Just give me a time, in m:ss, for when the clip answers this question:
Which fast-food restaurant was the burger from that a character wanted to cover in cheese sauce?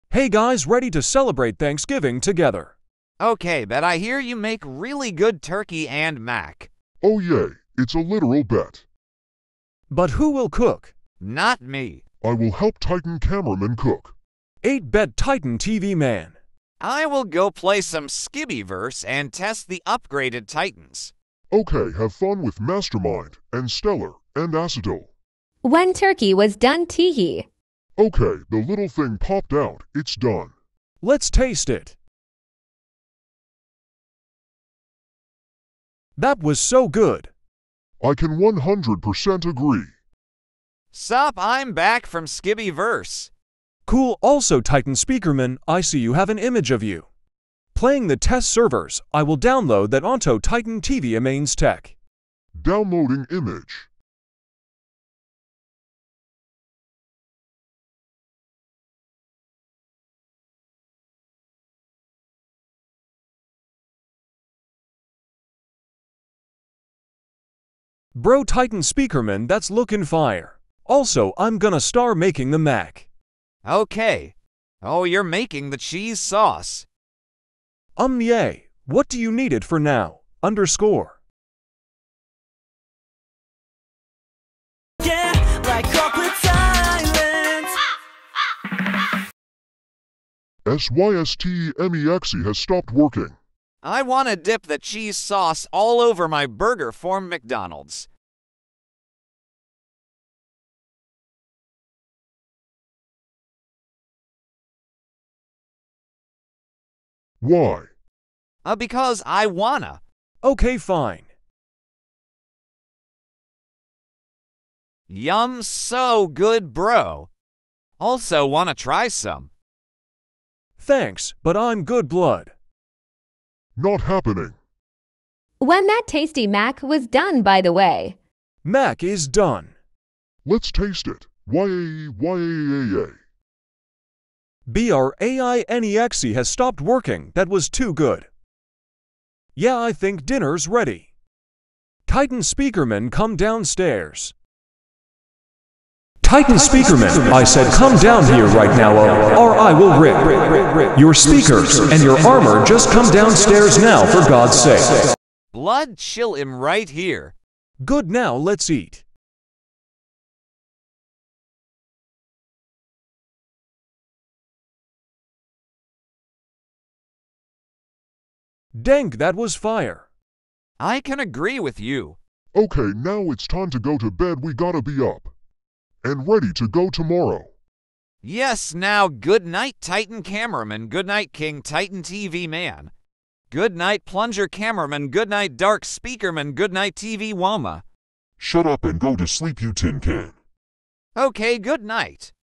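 1:37.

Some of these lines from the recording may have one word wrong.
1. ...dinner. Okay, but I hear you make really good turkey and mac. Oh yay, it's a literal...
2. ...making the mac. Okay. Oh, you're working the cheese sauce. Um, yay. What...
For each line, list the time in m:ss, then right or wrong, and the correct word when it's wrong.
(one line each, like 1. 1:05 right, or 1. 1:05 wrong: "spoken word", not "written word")
1. 0:02 wrong: "together", not "dinner"
2. 1:12 wrong: "making", not "working".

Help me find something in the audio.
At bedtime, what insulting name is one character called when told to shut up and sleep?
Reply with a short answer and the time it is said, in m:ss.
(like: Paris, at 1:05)
tin can, at 3:09.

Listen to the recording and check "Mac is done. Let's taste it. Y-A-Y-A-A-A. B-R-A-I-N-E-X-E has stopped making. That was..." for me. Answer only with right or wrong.
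wrong.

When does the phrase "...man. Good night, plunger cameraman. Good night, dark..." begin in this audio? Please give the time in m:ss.
3:02.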